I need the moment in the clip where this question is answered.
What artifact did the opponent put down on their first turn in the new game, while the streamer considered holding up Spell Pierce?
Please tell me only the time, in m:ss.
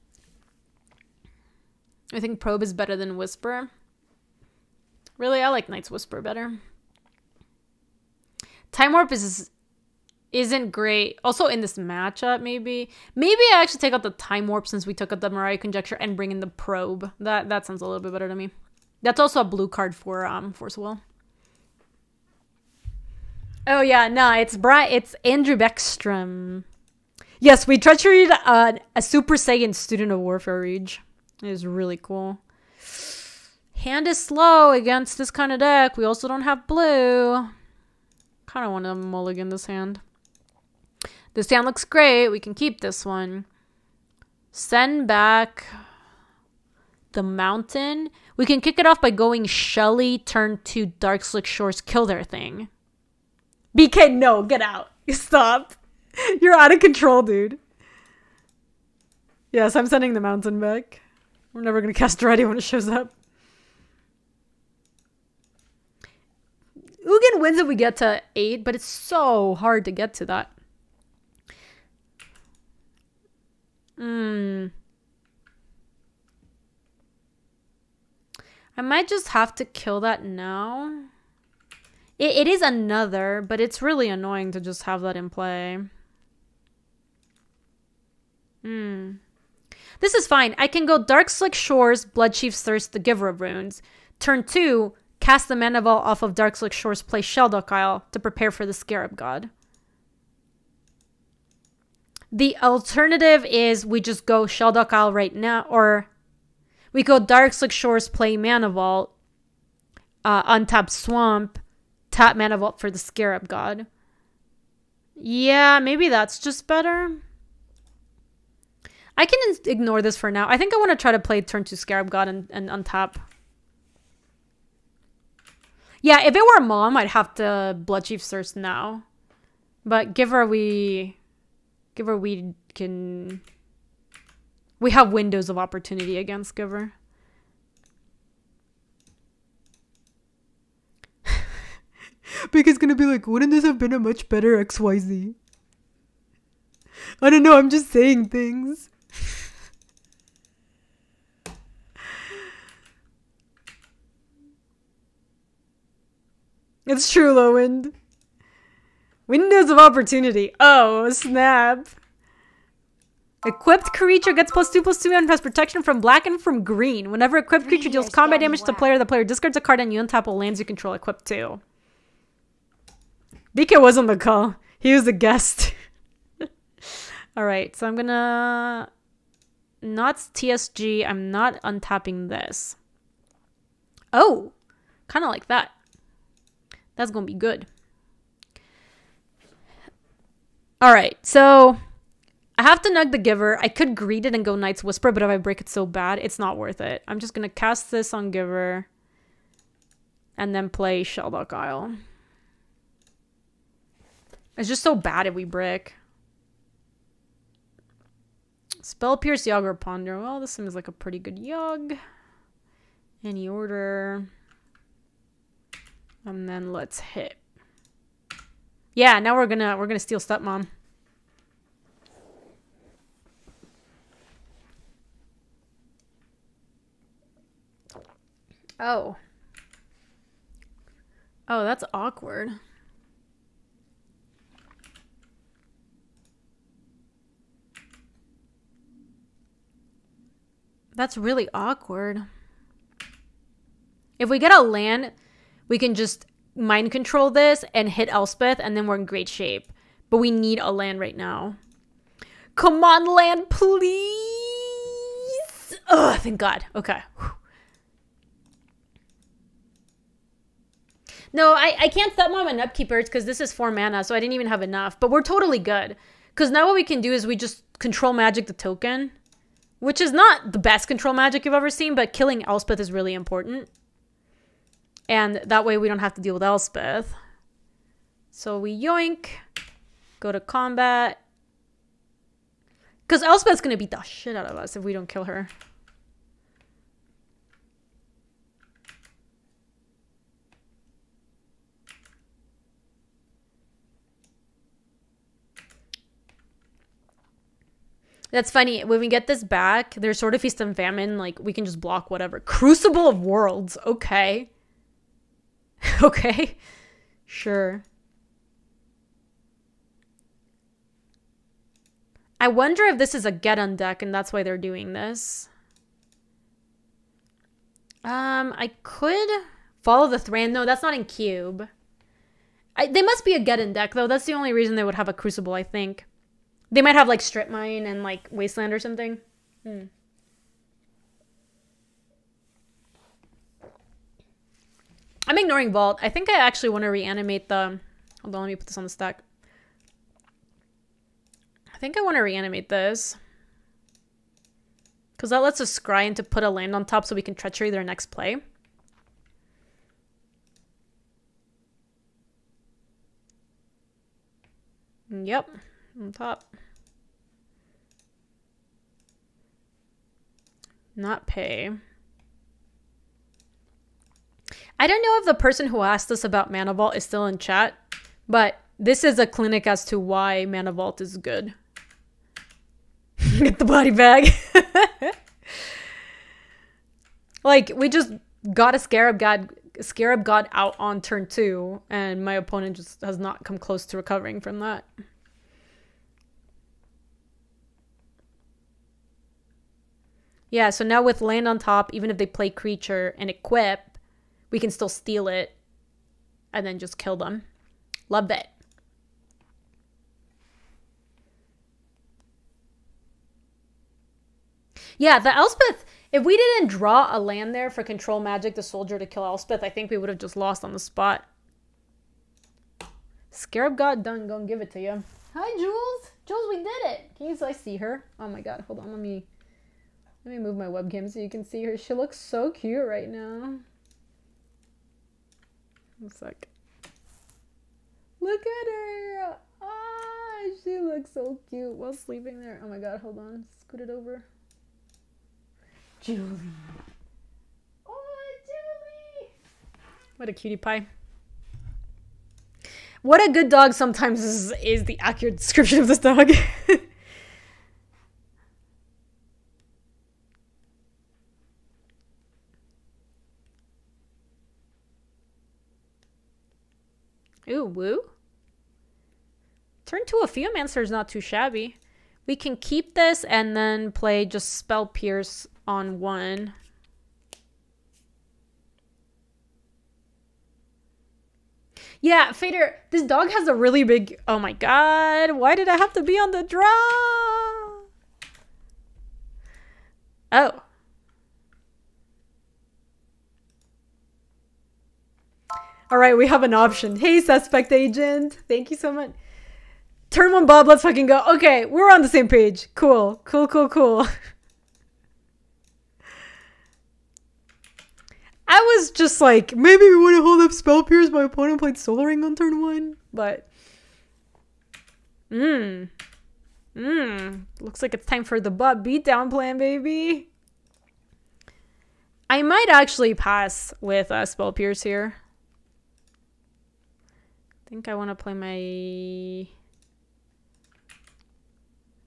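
8:21.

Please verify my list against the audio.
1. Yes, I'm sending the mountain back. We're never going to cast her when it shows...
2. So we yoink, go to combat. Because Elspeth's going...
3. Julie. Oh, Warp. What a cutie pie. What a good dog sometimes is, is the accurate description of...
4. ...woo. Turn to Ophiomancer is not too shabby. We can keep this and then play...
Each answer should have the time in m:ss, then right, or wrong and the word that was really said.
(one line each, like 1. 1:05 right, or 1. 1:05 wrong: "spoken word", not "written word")
1. 0:59 right
2. 4:38 right
3. 7:16 wrong: "Julie", not "Warp"
4. 7:37 right.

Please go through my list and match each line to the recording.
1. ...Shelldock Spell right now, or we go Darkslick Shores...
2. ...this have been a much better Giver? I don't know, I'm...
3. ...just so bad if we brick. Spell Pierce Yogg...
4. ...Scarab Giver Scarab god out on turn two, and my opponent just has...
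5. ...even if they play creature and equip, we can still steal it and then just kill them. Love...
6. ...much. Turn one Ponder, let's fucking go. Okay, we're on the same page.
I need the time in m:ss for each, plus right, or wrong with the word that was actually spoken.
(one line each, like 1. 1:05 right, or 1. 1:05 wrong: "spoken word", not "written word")
1. 1:44 wrong: "Isle", not "Spell"
2. 2:23 wrong: "XYZ", not "Giver"
3. 3:24 right
4. 6:18 wrong: "God", not "Giver"
5. 6:31 right
6. 8:08 wrong: "Bob", not "Ponder".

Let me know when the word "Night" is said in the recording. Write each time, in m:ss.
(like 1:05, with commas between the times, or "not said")
0:05, 3:14.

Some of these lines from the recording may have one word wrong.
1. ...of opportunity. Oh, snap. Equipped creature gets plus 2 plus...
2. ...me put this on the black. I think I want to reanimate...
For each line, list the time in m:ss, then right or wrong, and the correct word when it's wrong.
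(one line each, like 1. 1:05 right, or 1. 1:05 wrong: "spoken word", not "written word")
1. 2:39 right
2. 5:38 wrong: "stack", not "black".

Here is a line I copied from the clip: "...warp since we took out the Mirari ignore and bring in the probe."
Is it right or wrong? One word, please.
wrong.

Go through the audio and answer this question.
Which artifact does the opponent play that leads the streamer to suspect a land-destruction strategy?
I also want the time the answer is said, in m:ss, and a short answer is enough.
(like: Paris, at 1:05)
Crucible of Worlds, at 5:02.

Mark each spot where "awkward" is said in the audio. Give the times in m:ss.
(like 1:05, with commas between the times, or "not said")
3:51, 4:01.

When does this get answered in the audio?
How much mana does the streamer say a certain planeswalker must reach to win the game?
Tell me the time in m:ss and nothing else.
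1:08.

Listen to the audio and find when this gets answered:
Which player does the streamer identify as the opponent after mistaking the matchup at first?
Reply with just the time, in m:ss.
0:25.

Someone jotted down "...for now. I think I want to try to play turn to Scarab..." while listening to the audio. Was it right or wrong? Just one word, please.
right.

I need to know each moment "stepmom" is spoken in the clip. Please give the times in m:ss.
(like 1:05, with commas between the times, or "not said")
3:40.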